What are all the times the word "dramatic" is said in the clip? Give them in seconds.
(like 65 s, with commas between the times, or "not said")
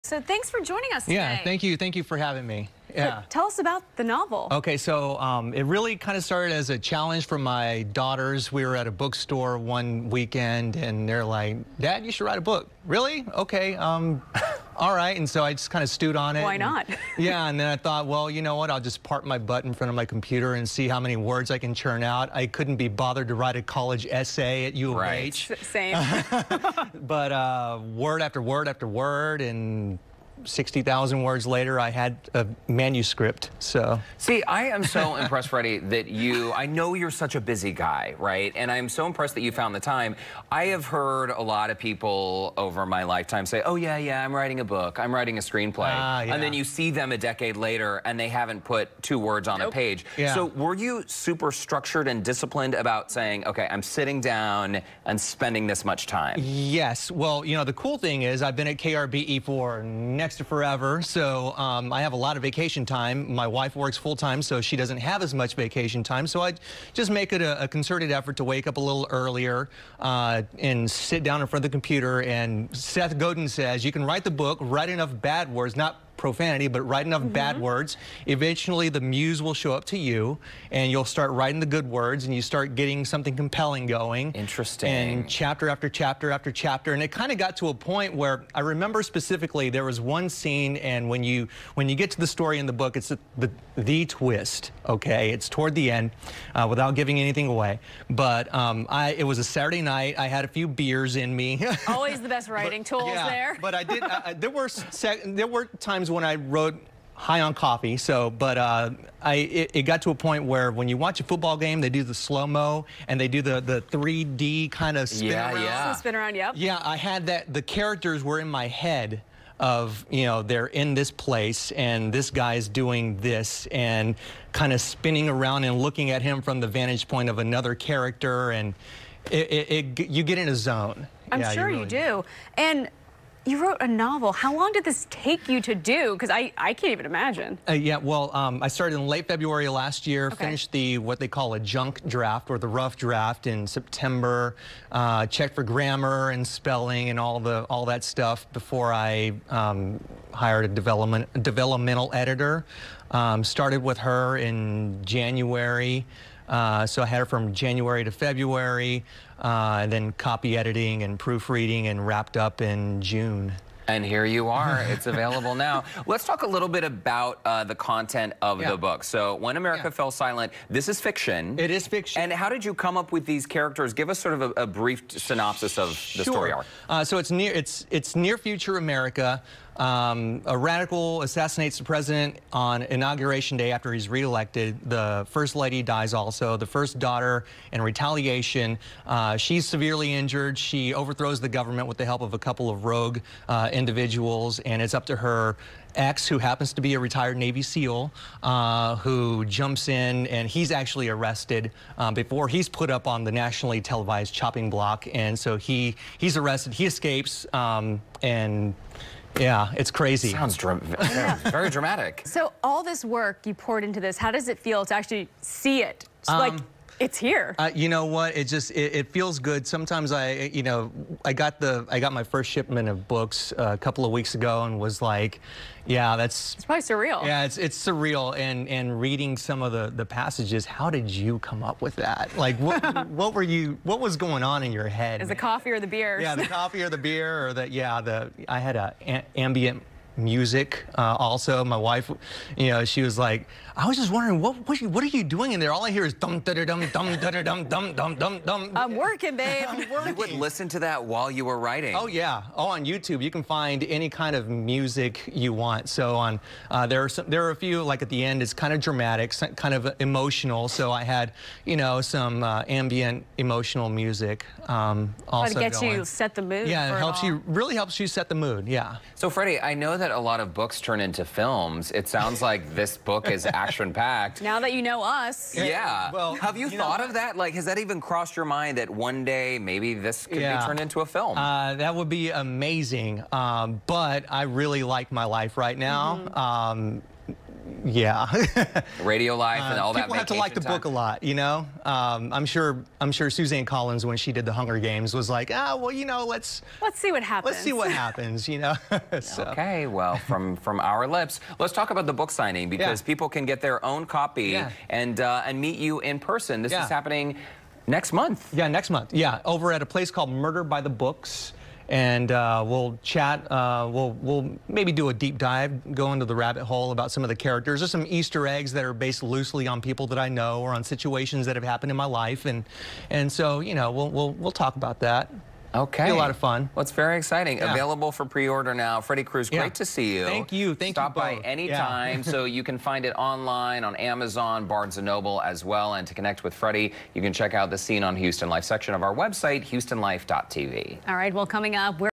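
211 s, 258 s.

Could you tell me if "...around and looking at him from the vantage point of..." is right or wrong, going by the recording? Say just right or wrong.
right.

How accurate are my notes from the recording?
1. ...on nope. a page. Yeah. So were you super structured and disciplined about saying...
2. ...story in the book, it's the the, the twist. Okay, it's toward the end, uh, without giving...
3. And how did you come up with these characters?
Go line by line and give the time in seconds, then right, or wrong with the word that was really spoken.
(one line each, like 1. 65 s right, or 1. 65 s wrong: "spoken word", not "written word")
1. 49 s right
2. 92 s right
3. 172 s right.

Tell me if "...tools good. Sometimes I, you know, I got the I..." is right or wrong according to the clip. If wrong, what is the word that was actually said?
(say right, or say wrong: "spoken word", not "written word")
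wrong: "feels", not "tools".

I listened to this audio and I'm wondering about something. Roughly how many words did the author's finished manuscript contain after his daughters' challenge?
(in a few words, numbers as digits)
60,000.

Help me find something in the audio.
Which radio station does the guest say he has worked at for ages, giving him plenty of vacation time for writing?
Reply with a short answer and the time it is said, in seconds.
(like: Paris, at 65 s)
KRBE, at 58 s.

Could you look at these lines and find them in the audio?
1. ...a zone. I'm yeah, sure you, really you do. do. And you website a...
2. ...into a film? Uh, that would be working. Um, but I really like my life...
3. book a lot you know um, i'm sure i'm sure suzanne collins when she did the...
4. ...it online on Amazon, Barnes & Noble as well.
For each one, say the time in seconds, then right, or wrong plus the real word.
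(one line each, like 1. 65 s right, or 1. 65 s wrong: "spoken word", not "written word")
1. 130 s wrong: "wrote", not "website"
2. 280 s wrong: "amazing", not "working"
3. 290 s right
4. 333 s right.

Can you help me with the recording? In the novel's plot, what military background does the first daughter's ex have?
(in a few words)
Retired Navy SEAL.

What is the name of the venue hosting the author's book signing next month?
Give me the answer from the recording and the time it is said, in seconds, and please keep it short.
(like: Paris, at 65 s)
Murder by the Books, at 310 s.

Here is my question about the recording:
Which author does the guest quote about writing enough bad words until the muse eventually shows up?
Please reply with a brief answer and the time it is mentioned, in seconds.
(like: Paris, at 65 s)
Seth Godin, at 72 s.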